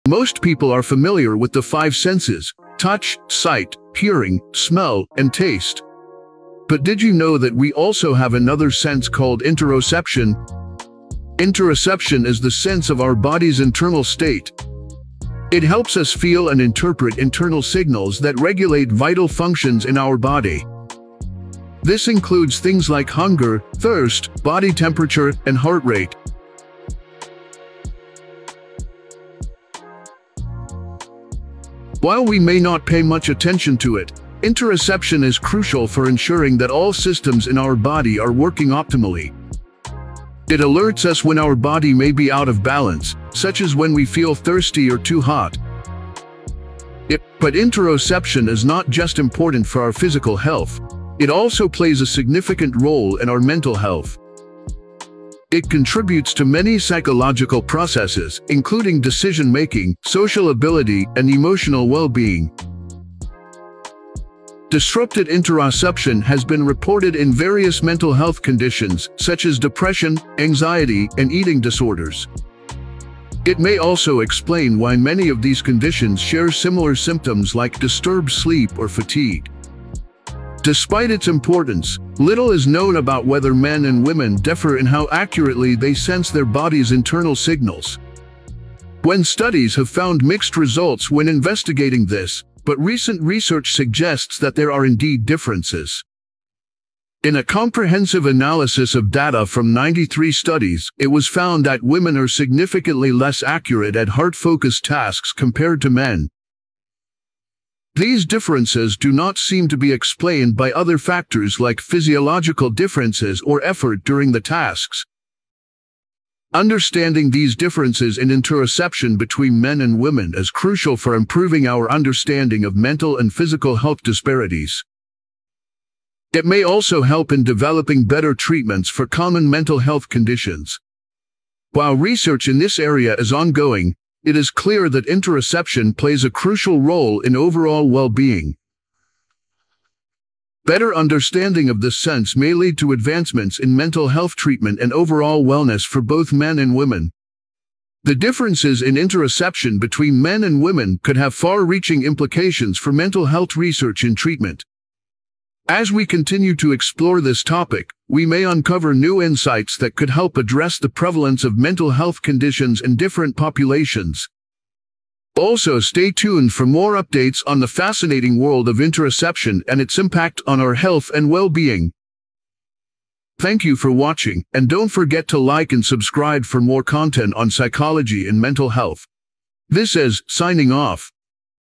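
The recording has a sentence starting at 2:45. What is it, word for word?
Also stay tuned for more updates on the fascinating world of interoception and its impact on our health and well-being.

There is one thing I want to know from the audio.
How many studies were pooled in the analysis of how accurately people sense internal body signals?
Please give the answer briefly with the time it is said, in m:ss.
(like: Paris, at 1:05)
93, at 1:39.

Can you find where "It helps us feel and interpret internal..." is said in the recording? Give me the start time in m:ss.
0:15.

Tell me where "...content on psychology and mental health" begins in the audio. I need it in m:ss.
2:56.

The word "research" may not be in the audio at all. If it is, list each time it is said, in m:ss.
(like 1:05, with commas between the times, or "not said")
1:33, 2:11, 2:33.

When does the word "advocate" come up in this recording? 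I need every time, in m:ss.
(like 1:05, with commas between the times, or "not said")
not said.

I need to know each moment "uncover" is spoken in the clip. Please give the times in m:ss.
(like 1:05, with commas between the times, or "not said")
2:38.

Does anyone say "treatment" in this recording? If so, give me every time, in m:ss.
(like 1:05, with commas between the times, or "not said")
2:08, 2:24, 2:34.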